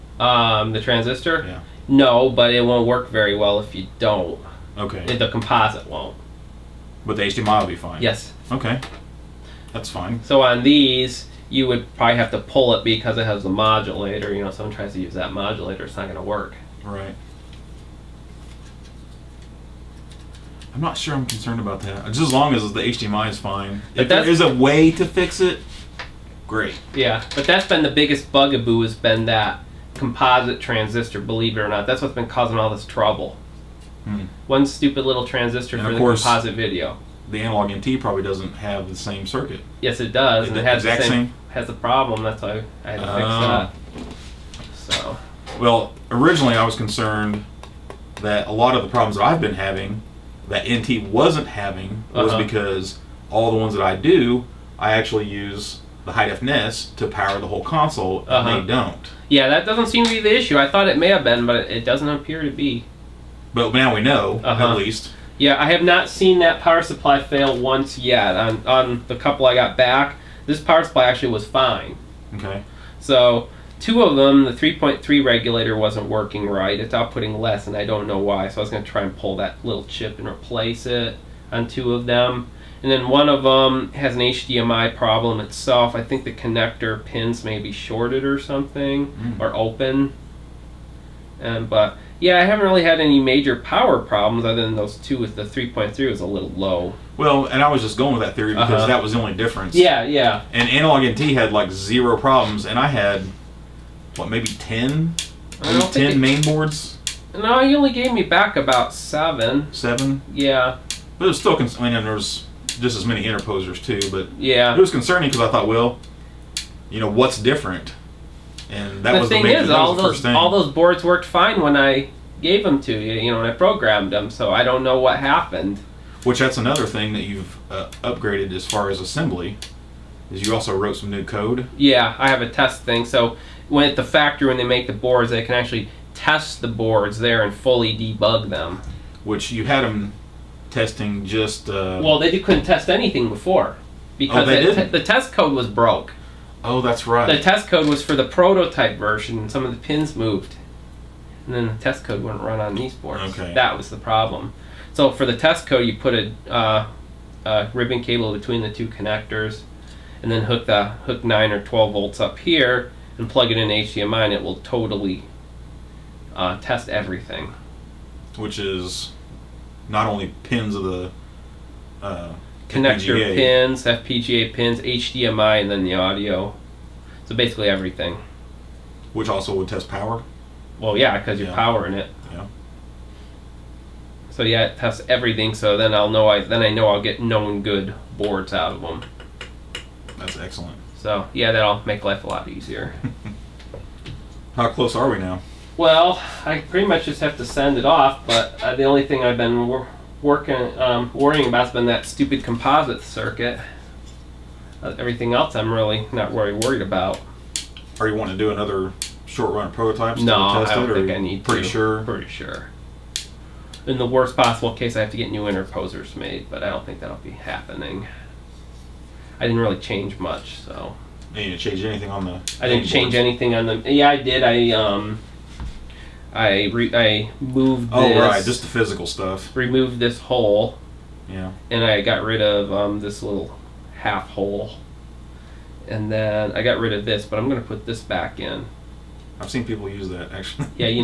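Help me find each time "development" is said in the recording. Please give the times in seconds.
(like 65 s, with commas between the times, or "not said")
not said.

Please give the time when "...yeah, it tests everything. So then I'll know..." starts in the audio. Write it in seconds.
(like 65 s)
184 s.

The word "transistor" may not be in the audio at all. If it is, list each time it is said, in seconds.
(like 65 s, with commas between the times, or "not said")
0 s, 30 s, 35 s.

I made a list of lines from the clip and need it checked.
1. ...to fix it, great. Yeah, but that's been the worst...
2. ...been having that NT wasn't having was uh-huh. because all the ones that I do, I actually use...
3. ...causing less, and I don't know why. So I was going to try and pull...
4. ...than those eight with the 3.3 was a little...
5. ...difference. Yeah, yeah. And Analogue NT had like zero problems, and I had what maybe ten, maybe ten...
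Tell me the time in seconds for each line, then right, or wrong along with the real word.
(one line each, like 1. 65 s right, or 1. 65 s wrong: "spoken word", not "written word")
1. 24 s wrong: "biggest", not "worst"
2. 49 s right
3. 76 s wrong: "outputting", not "causing"
4. 94 s wrong: "two", not "eight"
5. 99 s right.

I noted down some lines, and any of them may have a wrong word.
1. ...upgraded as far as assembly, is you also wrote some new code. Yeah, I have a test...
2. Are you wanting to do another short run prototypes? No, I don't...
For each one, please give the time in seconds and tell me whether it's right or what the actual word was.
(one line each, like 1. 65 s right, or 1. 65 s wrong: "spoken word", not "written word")
1. 128 s right
2. 208 s right.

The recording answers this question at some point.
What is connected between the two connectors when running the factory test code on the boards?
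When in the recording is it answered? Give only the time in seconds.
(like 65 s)
157 s.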